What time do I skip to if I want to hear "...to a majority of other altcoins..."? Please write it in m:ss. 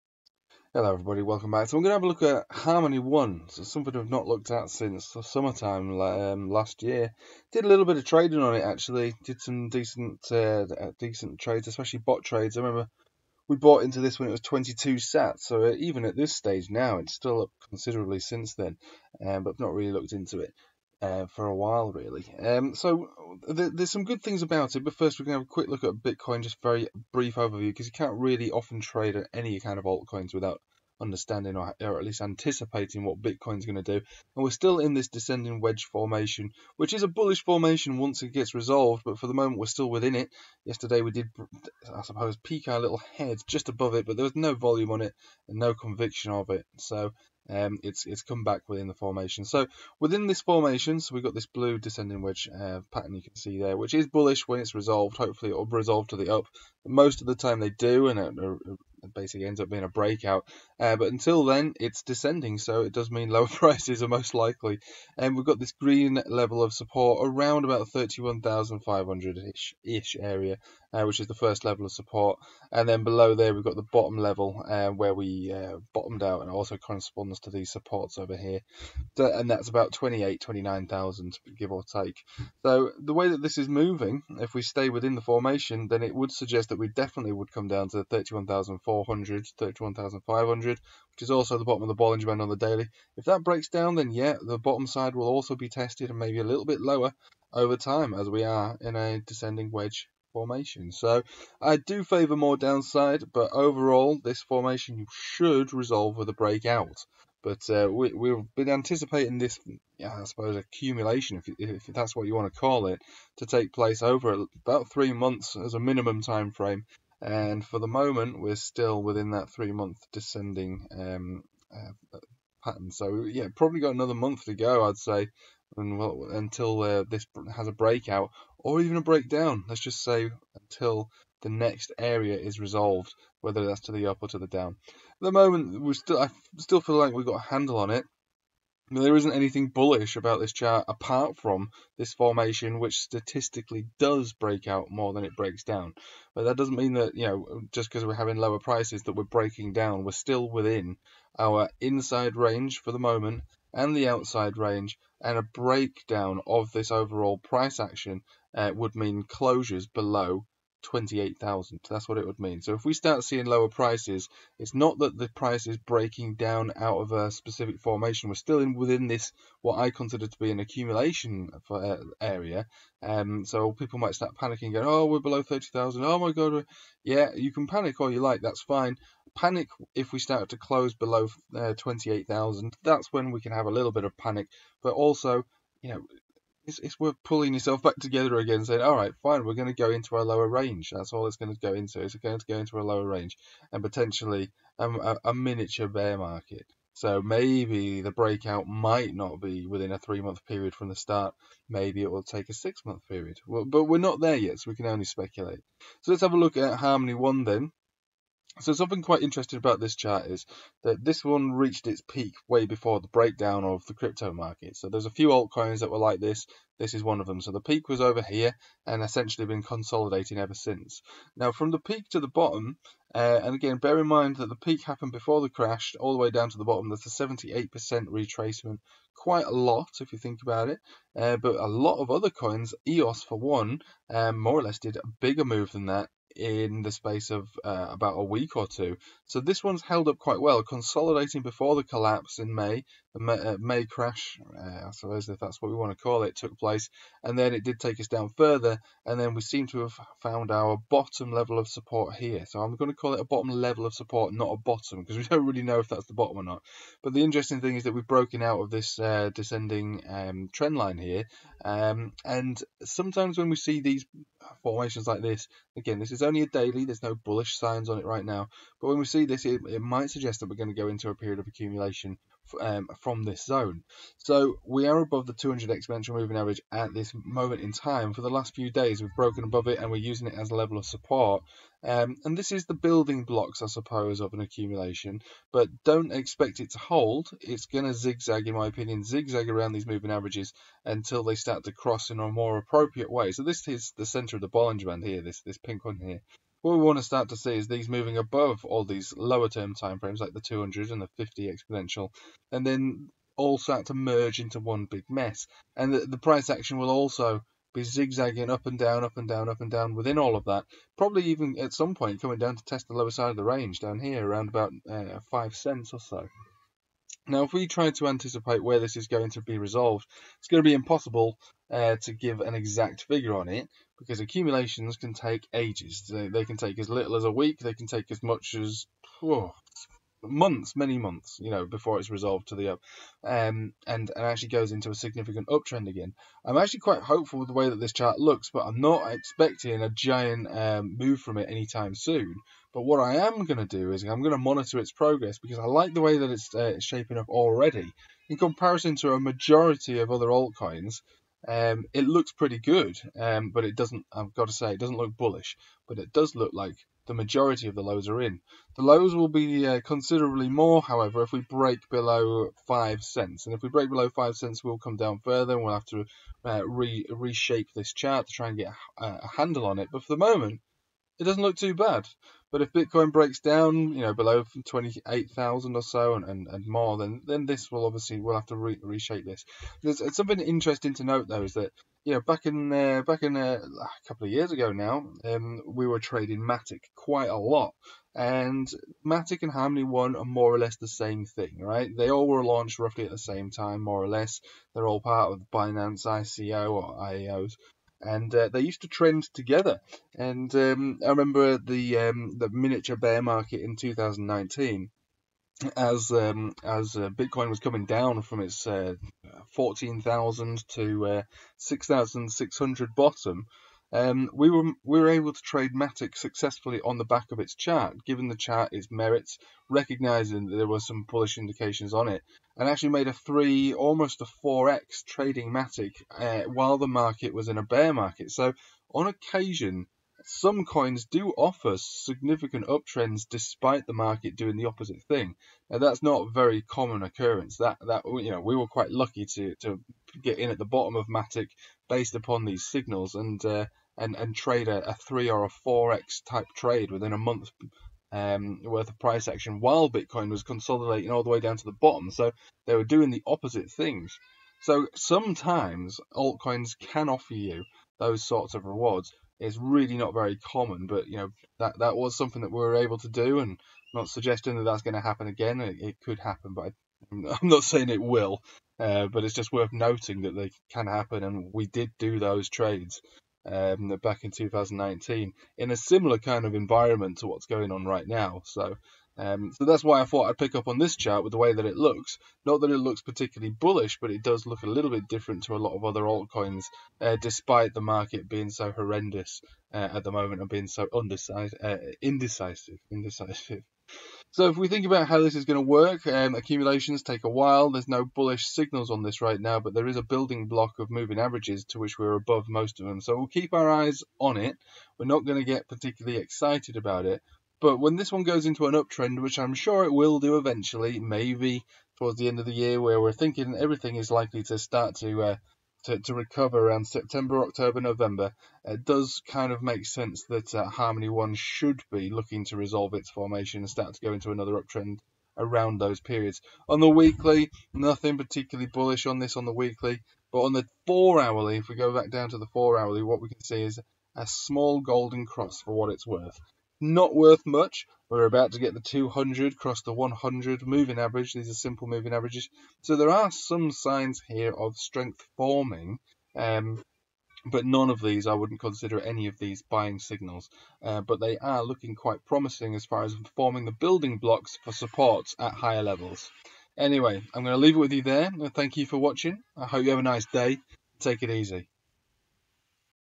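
5:48.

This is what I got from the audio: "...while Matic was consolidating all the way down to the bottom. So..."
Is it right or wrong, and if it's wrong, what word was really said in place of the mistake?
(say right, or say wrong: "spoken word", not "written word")
wrong: "Bitcoin", not "Matic".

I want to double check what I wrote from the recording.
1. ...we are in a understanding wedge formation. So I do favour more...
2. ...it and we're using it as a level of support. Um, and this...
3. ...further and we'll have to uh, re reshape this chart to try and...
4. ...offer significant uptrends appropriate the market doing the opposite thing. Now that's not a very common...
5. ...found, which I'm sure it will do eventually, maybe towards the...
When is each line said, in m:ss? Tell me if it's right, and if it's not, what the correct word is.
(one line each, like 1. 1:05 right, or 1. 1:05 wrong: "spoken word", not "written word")
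1. 1:38 wrong: "descending", not "understanding"
2. 4:39 right
3. 6:05 right
4. 7:11 wrong: "despite", not "appropriate"
5. 8:28 wrong: "uptrend", not "found".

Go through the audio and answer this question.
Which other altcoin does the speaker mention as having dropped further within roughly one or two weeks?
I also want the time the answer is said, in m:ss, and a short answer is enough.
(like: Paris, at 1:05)
EOS, at 3:52.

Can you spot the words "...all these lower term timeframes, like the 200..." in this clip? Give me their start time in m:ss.
4:58.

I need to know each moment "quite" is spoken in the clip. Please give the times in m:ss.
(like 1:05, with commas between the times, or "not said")
3:29, 3:49, 4:00, 5:36, 6:26, 7:18, 9:11.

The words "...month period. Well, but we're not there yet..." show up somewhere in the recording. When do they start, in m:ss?
3:22.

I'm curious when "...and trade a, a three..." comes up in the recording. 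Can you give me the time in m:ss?
7:24.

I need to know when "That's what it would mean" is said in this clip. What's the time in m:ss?
2:41.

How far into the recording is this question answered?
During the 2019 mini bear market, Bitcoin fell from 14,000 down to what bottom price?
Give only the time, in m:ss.
6:51.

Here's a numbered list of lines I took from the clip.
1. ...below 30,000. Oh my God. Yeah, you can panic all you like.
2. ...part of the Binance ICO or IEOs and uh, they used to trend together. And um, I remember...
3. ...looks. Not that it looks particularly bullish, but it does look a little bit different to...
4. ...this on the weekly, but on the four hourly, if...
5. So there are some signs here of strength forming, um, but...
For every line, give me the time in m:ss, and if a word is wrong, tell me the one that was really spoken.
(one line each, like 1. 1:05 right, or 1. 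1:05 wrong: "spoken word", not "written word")
1. 2:55 right
2. 6:34 right
3. 8:01 right
4. 8:49 right
5. 9:02 right.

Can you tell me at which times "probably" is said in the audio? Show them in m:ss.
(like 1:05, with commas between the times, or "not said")
2:03, 5:10.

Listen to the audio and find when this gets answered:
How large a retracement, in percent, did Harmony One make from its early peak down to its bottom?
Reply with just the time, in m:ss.
3:47.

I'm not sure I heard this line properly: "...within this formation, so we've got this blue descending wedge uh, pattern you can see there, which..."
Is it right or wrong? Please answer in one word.
right.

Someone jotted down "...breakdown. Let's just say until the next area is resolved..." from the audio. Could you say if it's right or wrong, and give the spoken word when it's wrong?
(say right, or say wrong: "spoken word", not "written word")
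right.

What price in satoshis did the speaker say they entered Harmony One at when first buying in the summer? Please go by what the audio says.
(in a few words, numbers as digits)
22 sat.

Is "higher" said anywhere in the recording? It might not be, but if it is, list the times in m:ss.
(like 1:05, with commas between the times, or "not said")
9:15.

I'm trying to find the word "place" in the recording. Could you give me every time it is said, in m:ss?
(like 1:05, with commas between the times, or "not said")
1:53, 4:06.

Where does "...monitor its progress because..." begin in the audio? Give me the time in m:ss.
5:44.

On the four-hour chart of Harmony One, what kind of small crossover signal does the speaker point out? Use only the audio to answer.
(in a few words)
golden cross.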